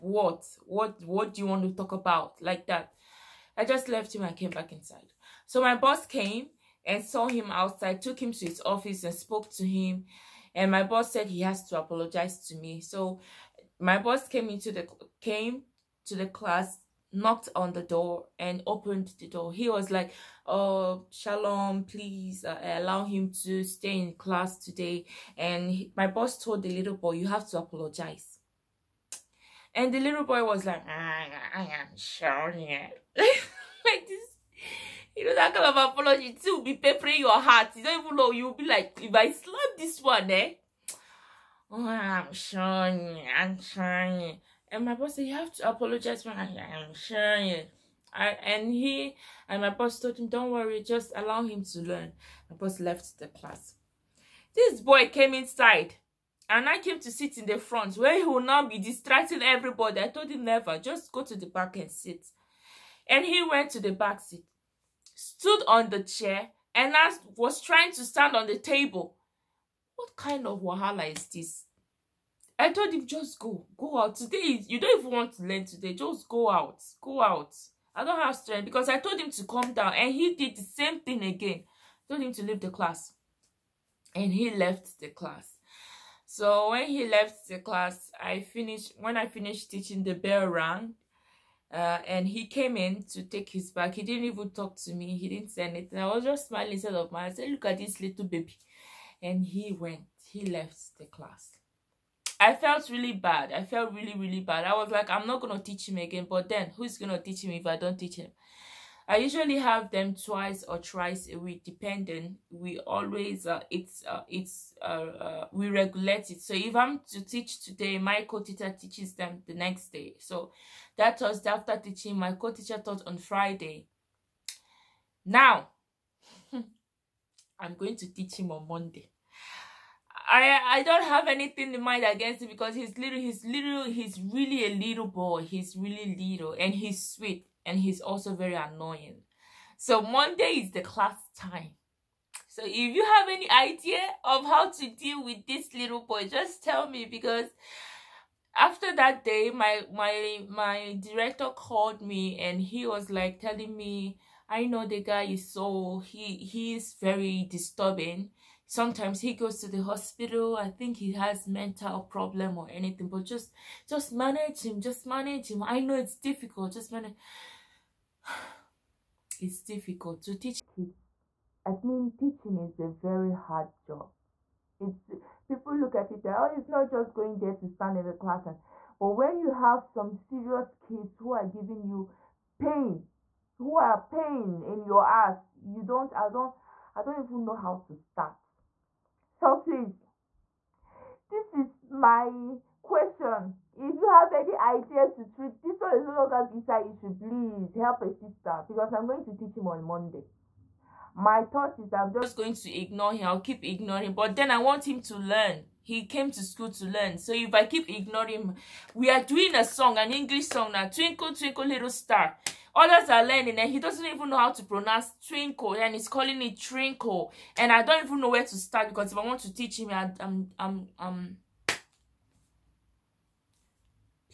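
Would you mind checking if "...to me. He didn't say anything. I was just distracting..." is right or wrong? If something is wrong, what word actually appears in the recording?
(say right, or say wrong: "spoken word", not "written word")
wrong: "smiling", not "distracting".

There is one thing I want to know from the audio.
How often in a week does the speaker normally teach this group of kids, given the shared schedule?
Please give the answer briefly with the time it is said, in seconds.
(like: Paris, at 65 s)
Twice or thrice, at 110 s.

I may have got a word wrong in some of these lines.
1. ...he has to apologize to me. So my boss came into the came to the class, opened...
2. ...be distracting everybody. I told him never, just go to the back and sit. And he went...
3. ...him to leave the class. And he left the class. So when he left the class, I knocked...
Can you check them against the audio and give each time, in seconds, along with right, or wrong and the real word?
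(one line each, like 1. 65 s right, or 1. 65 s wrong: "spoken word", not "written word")
1. 11 s wrong: "knocked", not "opened"
2. 58 s right
3. 82 s wrong: "finished", not "knocked".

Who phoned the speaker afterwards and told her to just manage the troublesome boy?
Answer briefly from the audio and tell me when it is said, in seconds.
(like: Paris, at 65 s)
Director, at 151 s.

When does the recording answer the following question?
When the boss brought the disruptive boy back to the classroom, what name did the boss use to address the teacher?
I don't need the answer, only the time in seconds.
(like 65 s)
21 s.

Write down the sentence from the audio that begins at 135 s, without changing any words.
He's really little and he's sweet and he's also very annoying.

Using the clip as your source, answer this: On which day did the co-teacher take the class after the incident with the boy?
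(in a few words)
Friday.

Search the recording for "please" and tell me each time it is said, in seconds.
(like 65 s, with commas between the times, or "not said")
21 s, 189 s, 197 s.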